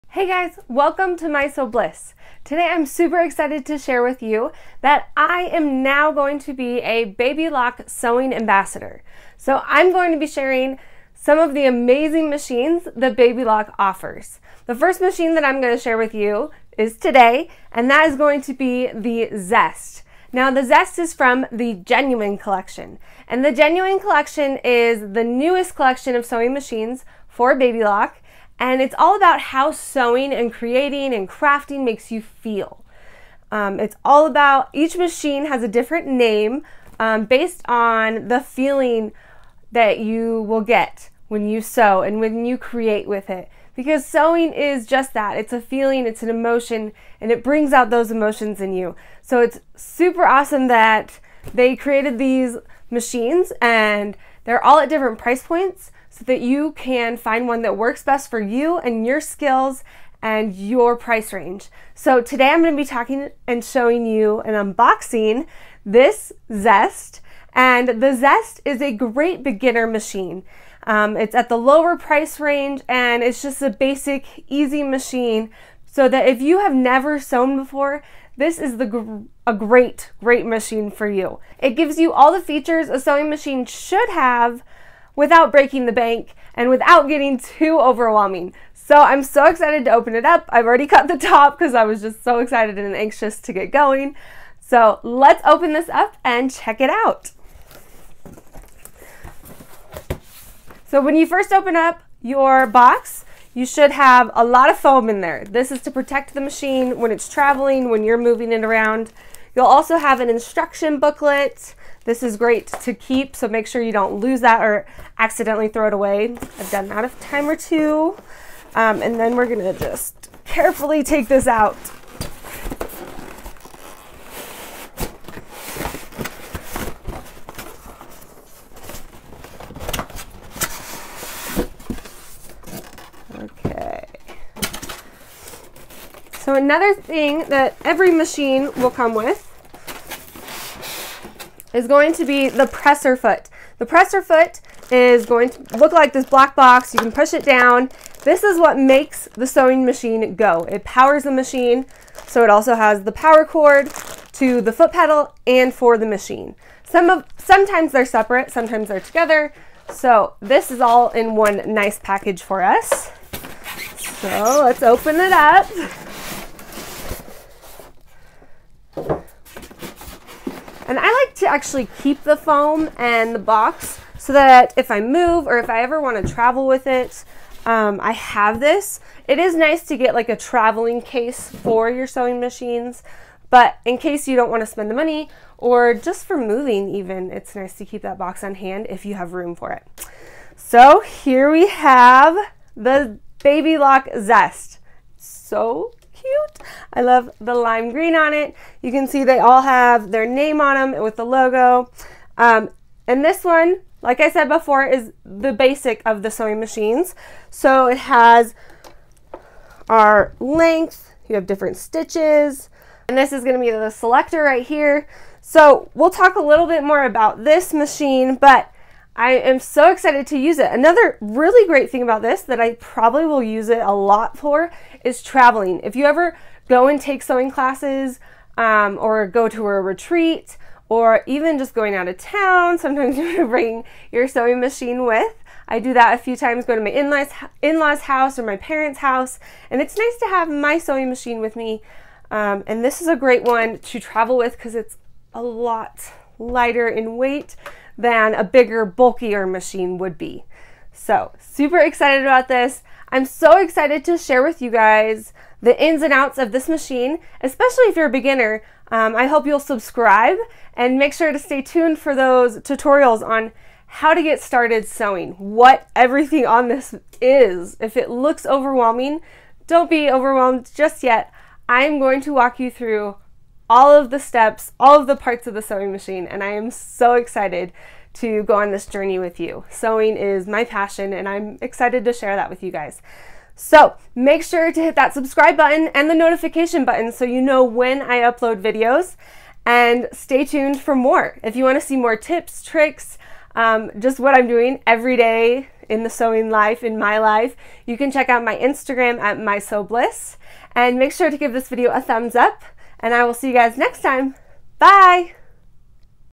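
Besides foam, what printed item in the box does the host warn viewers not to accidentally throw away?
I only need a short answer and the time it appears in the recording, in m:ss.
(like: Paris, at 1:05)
instruction booklet, at 1:50.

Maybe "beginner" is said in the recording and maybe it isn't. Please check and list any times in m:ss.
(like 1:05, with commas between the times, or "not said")
1:09, 4:18.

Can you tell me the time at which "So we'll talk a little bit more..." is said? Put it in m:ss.
3:35.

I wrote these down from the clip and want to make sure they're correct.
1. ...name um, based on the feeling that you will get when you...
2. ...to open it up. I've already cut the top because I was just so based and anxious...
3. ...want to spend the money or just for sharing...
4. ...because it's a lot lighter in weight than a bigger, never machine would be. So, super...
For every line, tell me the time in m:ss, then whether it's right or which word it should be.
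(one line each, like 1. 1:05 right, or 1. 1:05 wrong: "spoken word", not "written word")
1. 0:36 right
2. 1:29 wrong: "excited", not "based"
3. 3:04 wrong: "moving", not "sharing"
4. 4:04 wrong: "bulkier", not "never".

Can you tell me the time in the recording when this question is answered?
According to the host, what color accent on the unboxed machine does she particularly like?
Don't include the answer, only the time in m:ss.
3:17.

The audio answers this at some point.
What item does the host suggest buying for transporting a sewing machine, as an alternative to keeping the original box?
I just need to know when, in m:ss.
3:00.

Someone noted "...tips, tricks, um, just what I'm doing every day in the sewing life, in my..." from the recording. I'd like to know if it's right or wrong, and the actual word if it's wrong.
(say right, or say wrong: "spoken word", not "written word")
right.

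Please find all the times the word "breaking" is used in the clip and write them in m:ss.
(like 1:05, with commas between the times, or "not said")
1:25.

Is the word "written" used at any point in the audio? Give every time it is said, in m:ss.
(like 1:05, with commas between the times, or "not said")
not said.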